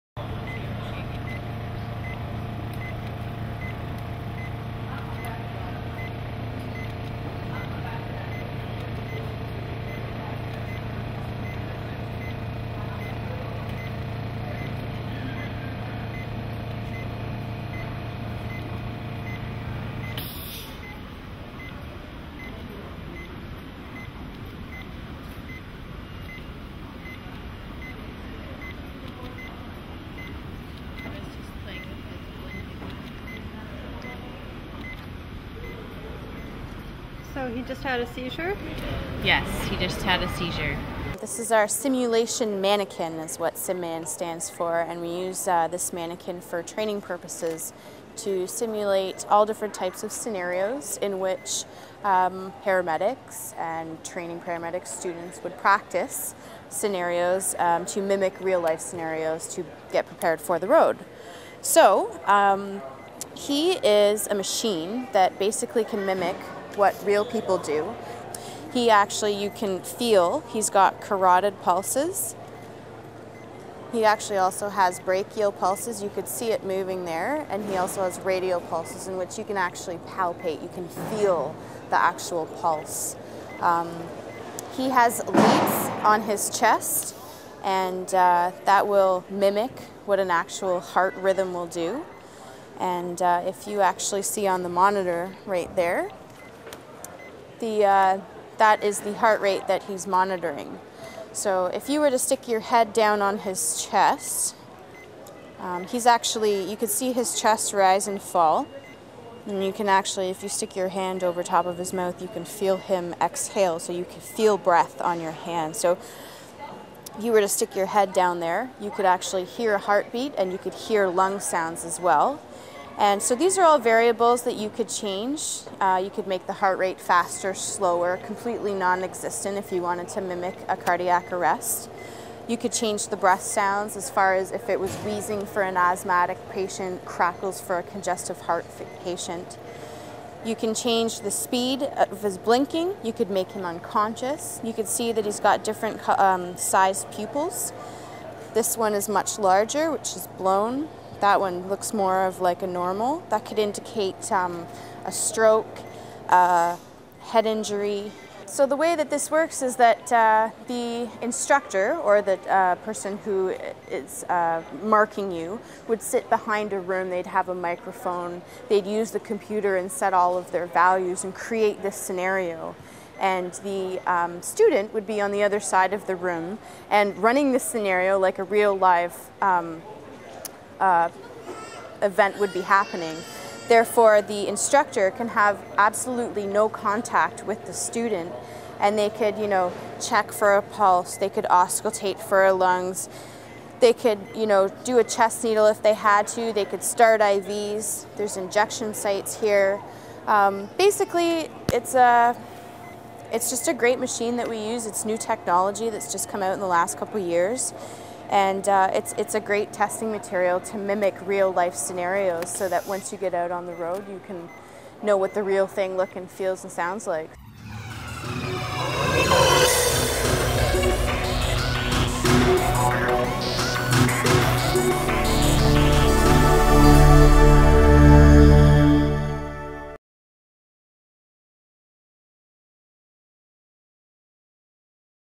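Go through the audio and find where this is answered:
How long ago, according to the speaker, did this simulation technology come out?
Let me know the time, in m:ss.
3:26.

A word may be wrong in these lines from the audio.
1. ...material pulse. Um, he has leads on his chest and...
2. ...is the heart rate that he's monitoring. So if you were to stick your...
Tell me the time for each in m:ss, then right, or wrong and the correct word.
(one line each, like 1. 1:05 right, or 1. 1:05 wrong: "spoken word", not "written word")
1. 1:21 wrong: "actual", not "material"
2. 1:38 right.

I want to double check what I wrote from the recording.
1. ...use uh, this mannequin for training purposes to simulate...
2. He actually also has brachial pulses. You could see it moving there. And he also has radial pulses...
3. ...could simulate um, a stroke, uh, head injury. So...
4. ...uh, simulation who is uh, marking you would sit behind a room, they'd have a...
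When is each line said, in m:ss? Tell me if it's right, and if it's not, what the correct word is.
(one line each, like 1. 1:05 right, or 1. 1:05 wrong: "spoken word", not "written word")
1. 0:45 right
2. 1:13 right
3. 2:33 wrong: "indicate", not "simulate"
4. 2:42 wrong: "person", not "simulation".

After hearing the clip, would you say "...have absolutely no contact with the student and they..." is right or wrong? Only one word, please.
right.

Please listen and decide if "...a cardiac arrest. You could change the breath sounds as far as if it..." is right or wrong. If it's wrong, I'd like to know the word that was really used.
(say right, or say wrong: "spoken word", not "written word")
right.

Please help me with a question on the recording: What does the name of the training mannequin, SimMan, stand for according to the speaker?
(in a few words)
Simulation mannequin.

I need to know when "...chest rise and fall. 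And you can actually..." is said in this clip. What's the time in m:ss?
1:47.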